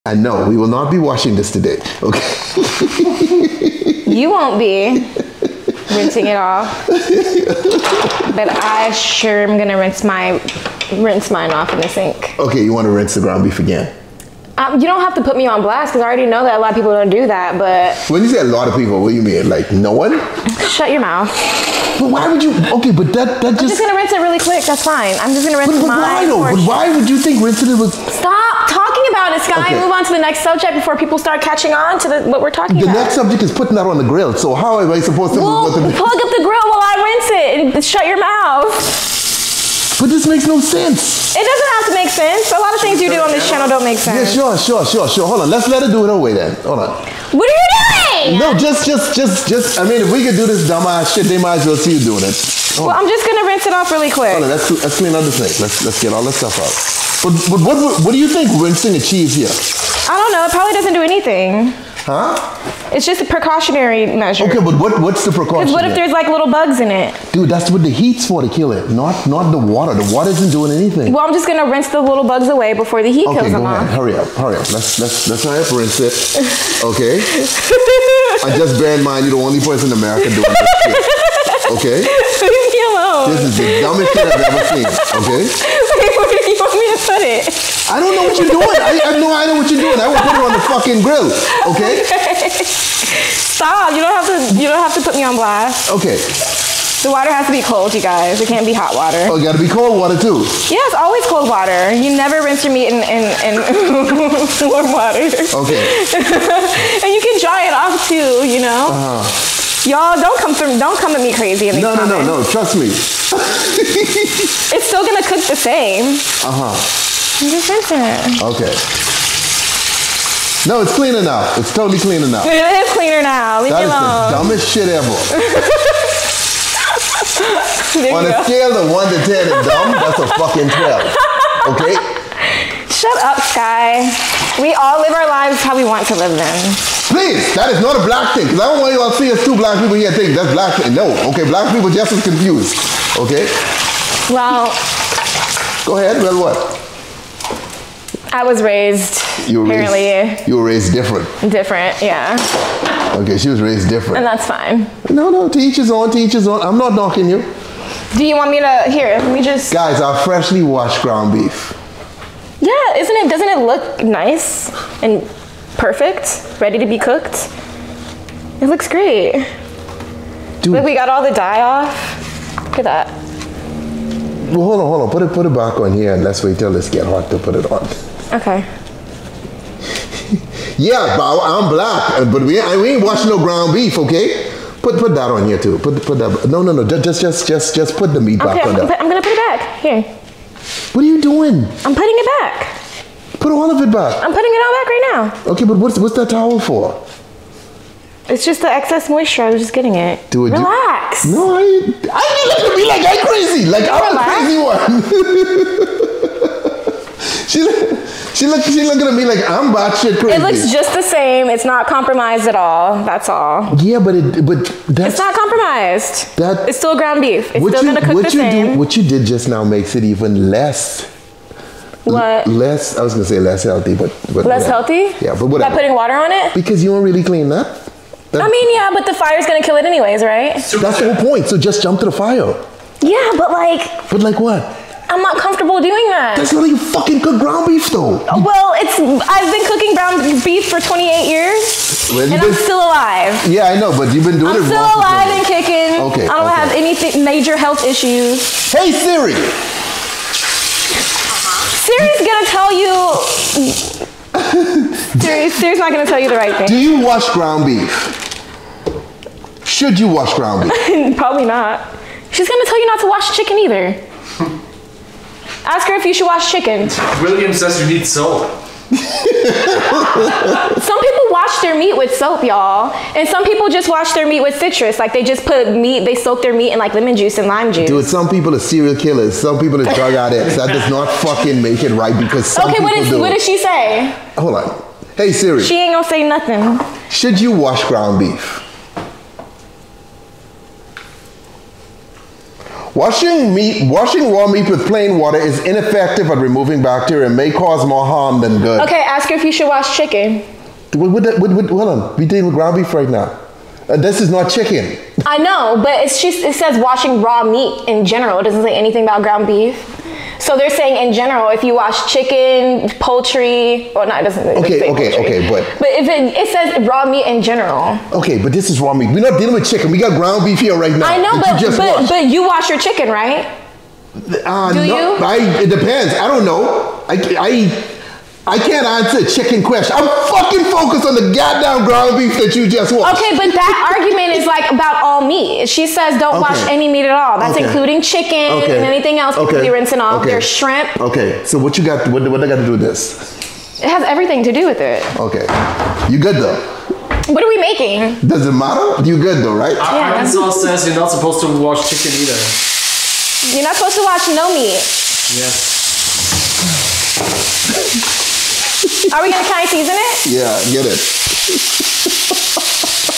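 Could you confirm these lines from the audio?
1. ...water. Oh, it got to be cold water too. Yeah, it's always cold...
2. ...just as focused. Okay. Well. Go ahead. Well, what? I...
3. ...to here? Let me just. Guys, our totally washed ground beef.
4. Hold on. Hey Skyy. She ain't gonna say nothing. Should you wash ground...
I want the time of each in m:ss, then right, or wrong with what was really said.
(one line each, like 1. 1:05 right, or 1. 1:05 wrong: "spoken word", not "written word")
1. 1:38 right
2. 2:21 wrong: "confused", not "focused"
3. 2:38 wrong: "freshly", not "totally"
4. 4:44 wrong: "Siri", not "Skyy".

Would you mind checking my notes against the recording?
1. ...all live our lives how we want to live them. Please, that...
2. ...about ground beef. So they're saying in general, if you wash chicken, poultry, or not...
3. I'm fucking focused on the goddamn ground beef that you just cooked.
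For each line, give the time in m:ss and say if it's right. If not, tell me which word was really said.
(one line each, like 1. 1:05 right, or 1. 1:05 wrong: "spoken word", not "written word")
1. 2:14 right
2. 5:09 right
3. 5:29 wrong: "watched", not "cooked".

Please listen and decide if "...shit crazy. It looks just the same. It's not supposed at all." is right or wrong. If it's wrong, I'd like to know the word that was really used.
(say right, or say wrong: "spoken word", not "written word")
wrong: "compromised", not "supposed".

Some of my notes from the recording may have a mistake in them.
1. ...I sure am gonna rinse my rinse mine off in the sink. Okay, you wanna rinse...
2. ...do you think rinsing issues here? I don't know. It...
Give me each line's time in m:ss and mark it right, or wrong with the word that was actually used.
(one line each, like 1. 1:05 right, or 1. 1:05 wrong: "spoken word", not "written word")
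1. 0:08 right
2. 0:58 wrong: "achieves", not "issues".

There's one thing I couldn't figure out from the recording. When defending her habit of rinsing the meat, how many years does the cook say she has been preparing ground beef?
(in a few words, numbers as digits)
28.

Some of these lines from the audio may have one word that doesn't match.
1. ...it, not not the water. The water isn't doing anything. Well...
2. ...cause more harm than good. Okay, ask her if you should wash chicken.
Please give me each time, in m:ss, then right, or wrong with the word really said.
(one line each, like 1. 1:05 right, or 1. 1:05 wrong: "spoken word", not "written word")
1. 1:08 right
2. 4:57 right.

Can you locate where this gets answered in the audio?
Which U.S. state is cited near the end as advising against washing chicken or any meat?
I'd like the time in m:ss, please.
5:50.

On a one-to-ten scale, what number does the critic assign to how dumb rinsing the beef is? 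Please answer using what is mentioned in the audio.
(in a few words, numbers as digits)
12.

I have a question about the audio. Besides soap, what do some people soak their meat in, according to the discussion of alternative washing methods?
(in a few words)
Citrus.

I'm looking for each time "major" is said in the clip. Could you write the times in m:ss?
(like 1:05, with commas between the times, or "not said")
4:07.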